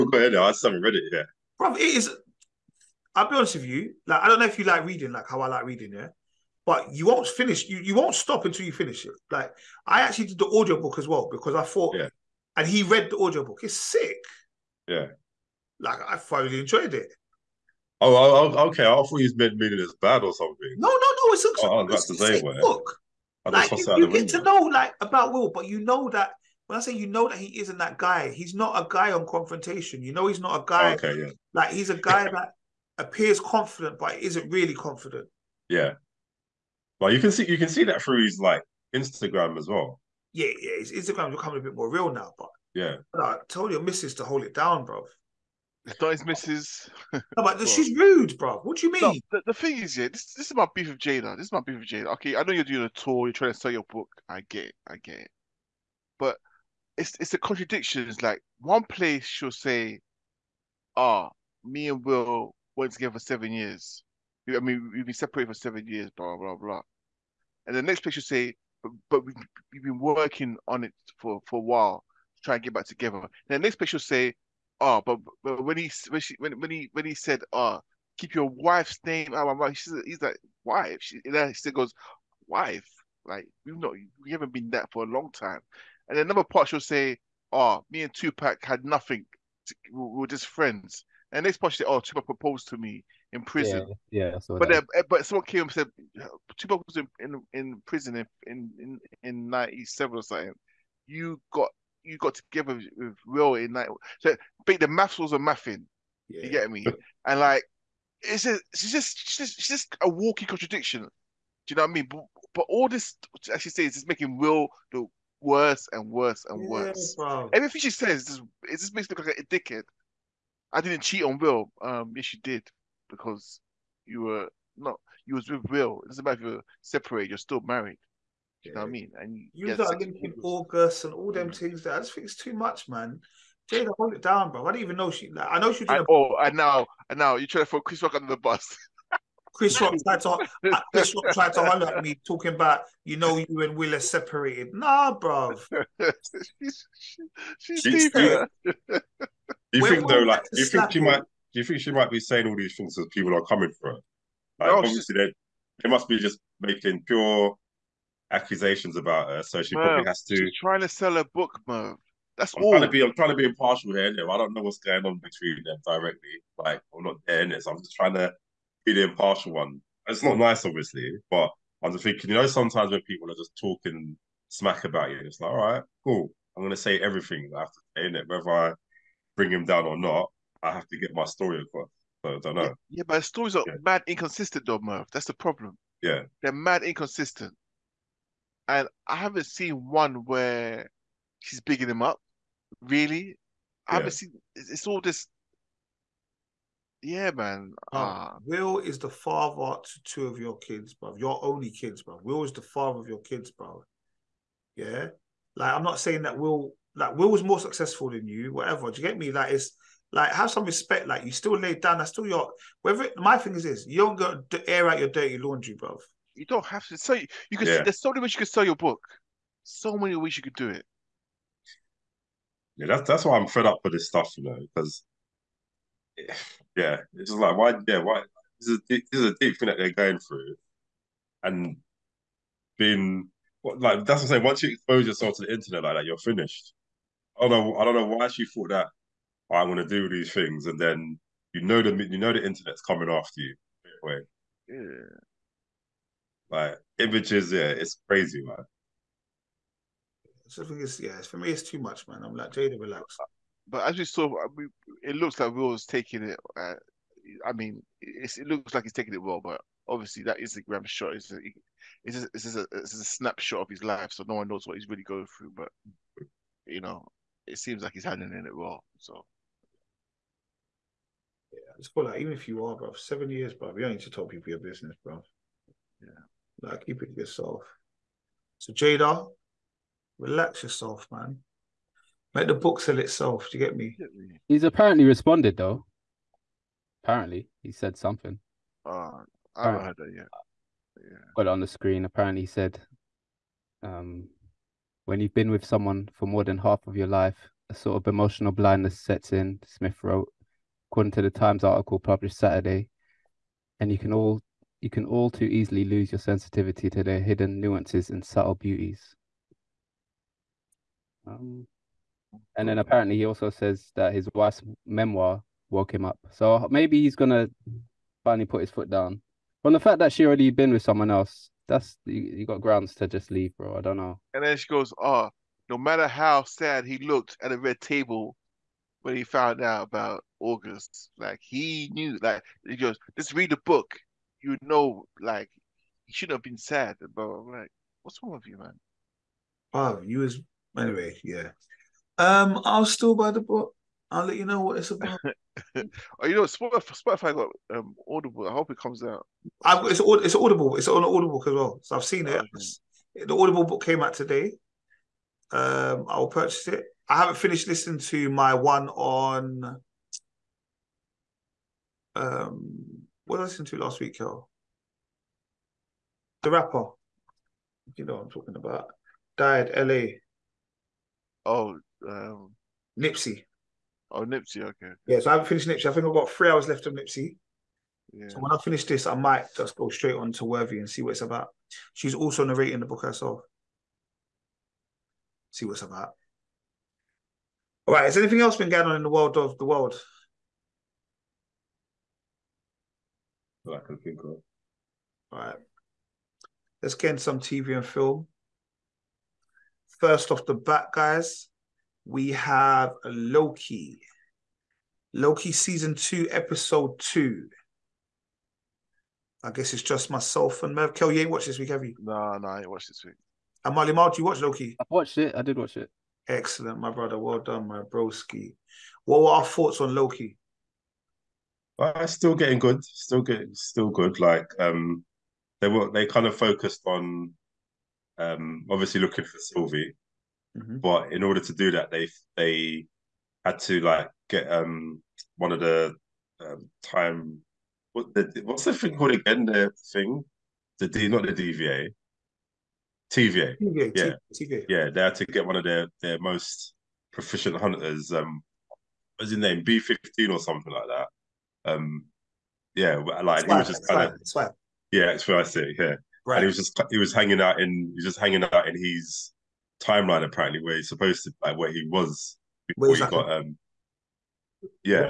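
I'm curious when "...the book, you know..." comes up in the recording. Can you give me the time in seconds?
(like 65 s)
333 s.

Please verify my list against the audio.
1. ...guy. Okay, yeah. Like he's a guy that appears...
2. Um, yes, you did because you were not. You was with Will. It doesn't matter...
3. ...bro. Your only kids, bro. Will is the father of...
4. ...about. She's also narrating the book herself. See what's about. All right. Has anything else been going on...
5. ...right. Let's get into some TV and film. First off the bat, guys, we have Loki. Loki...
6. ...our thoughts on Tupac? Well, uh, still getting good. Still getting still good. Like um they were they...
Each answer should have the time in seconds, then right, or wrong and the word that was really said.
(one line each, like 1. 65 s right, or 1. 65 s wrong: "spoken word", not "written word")
1. 30 s right
2. 121 s right
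3. 200 s right
4. 381 s right
5. 395 s right
6. 419 s wrong: "Loki", not "Tupac".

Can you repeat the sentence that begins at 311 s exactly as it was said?
Um, and then apparently he also says that his wife's memoir woke him up.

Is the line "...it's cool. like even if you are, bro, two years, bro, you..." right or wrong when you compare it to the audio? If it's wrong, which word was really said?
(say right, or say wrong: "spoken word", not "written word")
wrong: "seven", not "two".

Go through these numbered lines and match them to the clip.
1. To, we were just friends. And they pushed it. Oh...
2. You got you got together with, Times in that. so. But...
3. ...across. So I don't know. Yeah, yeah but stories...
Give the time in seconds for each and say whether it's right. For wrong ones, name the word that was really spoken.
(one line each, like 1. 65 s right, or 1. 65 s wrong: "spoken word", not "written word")
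1. 89 s right
2. 101 s wrong: "Will", not "Times"
3. 181 s right.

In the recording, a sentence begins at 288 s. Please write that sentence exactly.
Uh, I haven't heard that yet.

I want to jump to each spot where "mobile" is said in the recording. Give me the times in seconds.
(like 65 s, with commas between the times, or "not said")
not said.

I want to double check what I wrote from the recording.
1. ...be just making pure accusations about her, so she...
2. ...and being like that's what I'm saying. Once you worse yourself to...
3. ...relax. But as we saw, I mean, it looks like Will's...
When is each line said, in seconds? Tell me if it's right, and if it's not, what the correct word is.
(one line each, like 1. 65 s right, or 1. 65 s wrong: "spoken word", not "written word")
1. 156 s right
2. 231 s wrong: "expose", not "worse"
3. 252 s right.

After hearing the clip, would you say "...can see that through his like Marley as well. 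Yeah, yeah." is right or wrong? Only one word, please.
wrong.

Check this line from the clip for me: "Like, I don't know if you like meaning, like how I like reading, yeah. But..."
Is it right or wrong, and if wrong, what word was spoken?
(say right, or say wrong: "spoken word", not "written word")
wrong: "reading", not "meaning".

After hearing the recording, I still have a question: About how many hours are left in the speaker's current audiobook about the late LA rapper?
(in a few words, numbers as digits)
3.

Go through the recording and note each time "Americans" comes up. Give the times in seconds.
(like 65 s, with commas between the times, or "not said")
not said.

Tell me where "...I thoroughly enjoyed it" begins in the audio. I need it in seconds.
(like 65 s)
16 s.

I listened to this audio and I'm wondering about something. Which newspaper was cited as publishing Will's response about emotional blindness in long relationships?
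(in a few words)
The Times.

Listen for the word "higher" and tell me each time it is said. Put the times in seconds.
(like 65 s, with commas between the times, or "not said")
not said.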